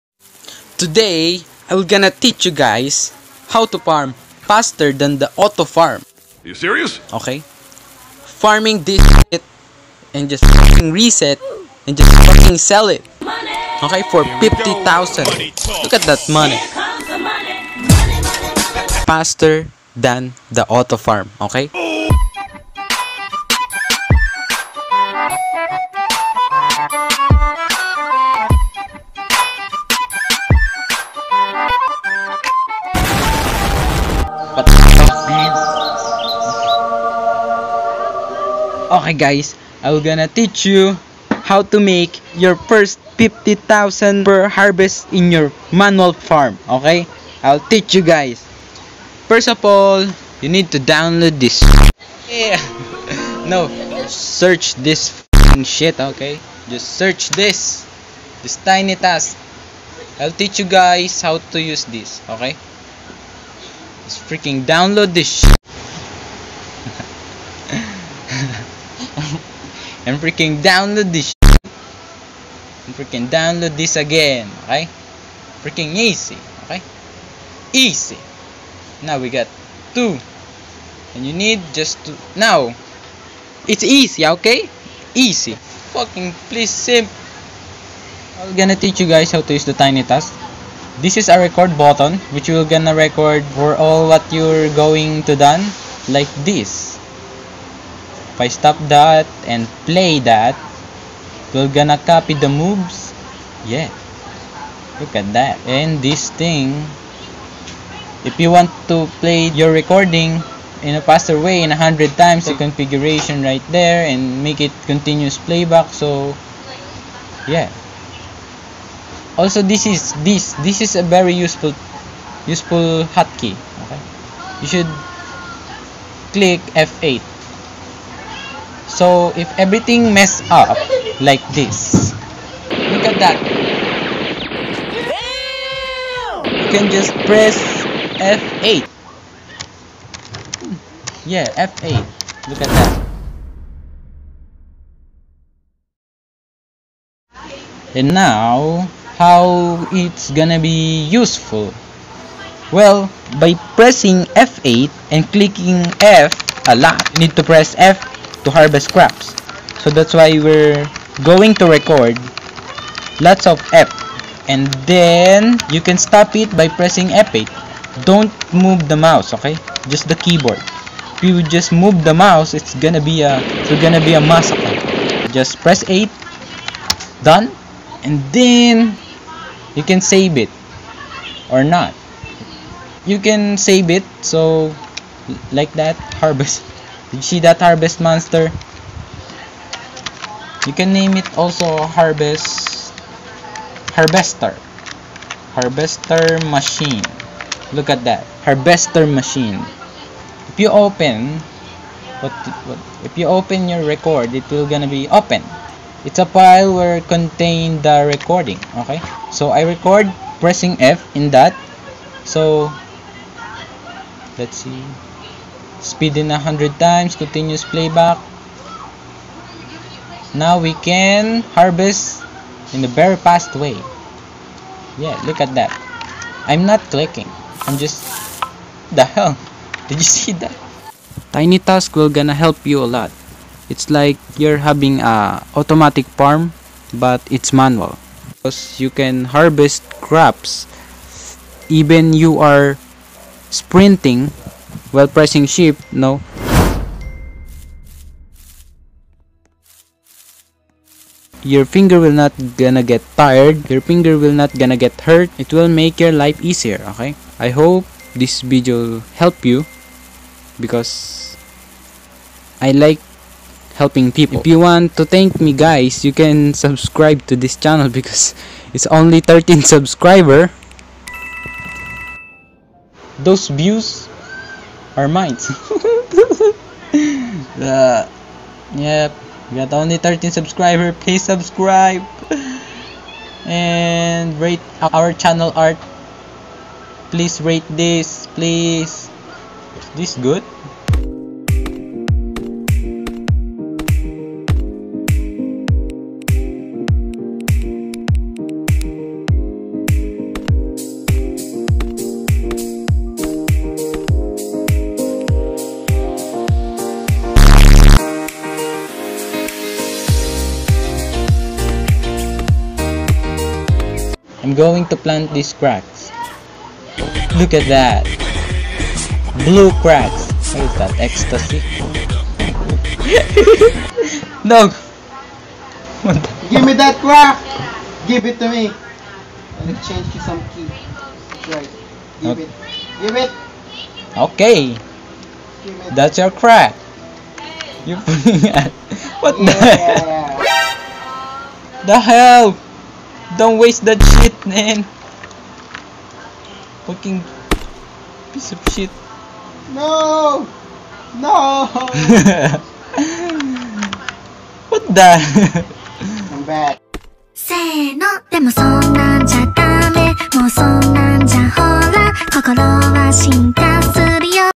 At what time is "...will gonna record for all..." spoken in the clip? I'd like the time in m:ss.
1:32.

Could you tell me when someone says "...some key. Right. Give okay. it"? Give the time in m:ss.
5:30.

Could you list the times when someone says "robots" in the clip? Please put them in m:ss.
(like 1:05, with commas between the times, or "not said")
not said.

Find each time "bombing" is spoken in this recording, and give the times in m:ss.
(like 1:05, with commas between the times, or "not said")
not said.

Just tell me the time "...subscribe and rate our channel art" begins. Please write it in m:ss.
4:41.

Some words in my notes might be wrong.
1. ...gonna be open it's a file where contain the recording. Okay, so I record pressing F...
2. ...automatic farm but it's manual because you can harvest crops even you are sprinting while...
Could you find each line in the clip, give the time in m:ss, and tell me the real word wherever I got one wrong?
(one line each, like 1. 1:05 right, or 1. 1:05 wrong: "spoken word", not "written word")
1. 3:24 right
2. 3:55 right.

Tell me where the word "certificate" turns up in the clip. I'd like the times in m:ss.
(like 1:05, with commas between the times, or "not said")
not said.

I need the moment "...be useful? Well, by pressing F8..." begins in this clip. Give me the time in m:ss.
2:30.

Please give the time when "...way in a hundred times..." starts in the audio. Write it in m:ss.
1:51.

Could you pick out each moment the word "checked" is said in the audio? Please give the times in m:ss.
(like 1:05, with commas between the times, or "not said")
not said.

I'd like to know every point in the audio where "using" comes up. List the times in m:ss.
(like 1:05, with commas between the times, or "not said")
not said.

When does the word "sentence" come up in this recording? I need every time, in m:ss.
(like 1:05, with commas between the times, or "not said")
not said.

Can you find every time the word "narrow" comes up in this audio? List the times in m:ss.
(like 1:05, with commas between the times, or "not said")
not said.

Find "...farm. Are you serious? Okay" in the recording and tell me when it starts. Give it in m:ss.
0:05.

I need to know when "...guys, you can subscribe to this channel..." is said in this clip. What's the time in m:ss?
4:25.